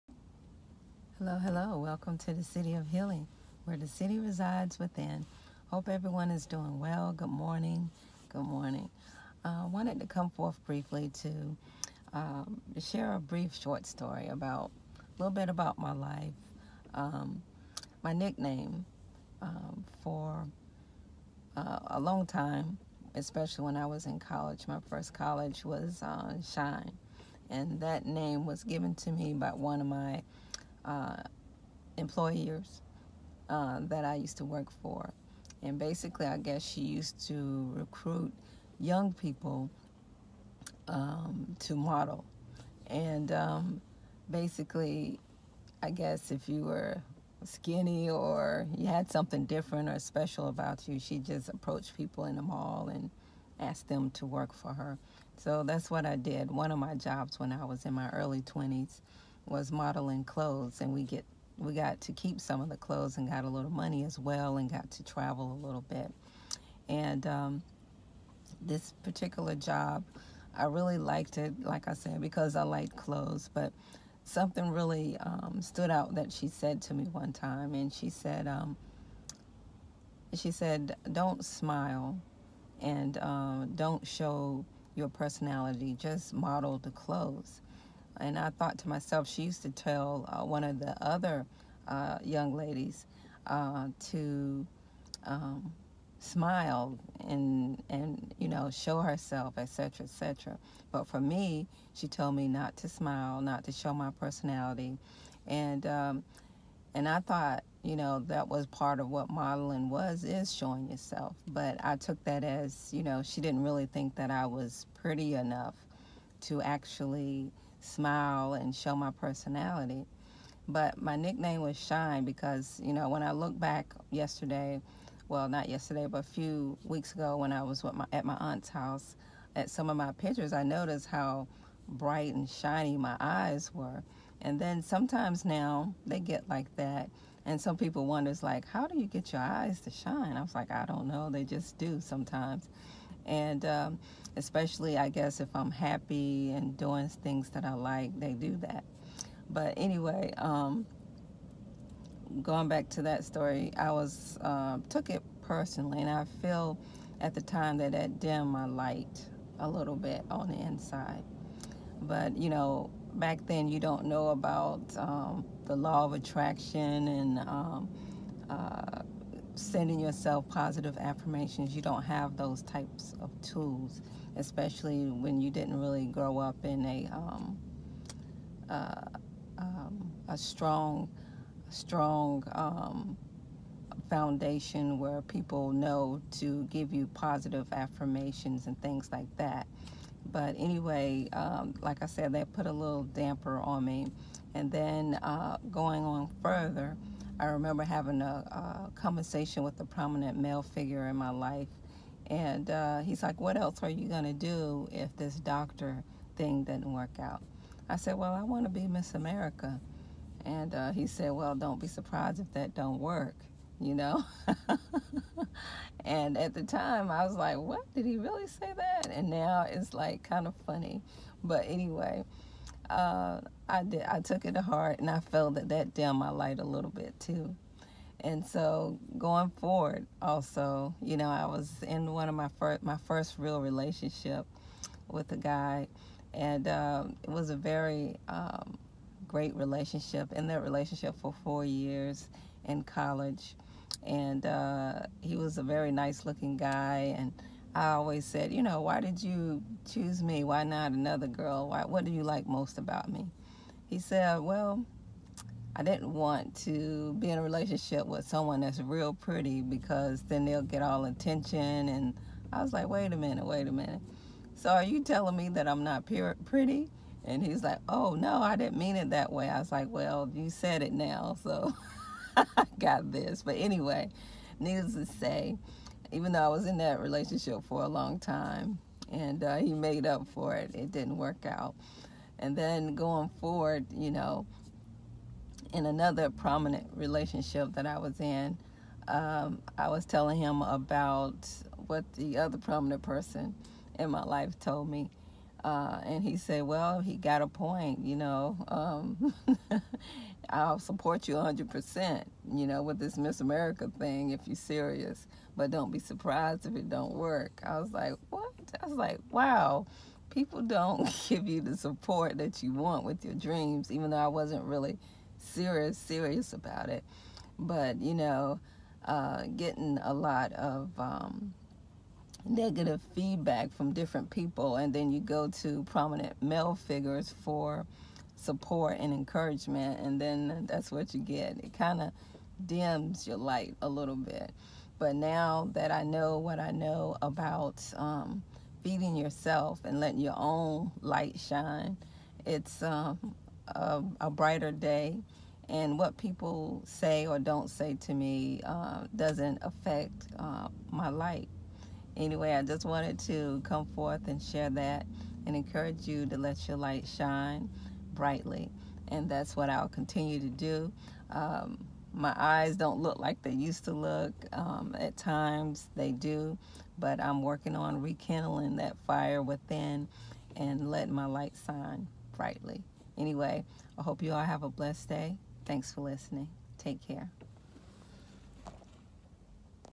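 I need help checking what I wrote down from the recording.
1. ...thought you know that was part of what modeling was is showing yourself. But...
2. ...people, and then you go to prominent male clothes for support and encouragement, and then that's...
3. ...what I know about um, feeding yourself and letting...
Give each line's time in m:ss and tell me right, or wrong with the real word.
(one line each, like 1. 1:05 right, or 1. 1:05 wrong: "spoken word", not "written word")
1. 1:47 right
2. 5:24 wrong: "figures", not "clothes"
3. 5:36 right.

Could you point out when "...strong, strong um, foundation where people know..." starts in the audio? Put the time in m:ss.
3:00.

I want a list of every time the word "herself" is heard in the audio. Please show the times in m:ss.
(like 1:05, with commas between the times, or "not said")
1:39.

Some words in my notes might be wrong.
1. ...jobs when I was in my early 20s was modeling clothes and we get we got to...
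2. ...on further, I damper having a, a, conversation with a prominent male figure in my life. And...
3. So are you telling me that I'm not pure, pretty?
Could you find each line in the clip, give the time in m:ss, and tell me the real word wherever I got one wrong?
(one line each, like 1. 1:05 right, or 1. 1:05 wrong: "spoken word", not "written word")
1. 0:56 right
2. 3:16 wrong: "remember", not "damper"
3. 4:24 right.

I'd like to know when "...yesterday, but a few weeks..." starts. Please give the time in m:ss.
2:05.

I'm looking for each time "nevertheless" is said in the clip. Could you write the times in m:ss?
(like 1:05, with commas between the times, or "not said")
not said.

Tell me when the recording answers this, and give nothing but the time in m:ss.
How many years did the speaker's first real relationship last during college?
4:01.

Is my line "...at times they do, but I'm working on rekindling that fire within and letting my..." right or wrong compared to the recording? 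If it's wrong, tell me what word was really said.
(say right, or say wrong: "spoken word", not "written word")
right.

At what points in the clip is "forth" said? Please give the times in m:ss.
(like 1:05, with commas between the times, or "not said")
0:10, 5:53.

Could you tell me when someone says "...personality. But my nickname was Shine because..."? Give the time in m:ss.
1:59.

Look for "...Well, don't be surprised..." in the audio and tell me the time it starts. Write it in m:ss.
3:31.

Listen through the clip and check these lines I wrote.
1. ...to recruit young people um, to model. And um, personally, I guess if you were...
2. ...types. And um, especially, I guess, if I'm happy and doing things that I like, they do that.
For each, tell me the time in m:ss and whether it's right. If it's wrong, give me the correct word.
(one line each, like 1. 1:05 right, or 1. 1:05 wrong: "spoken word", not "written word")
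1. 0:37 wrong: "basically", not "personally"
2. 2:21 wrong: "sometimes", not "types".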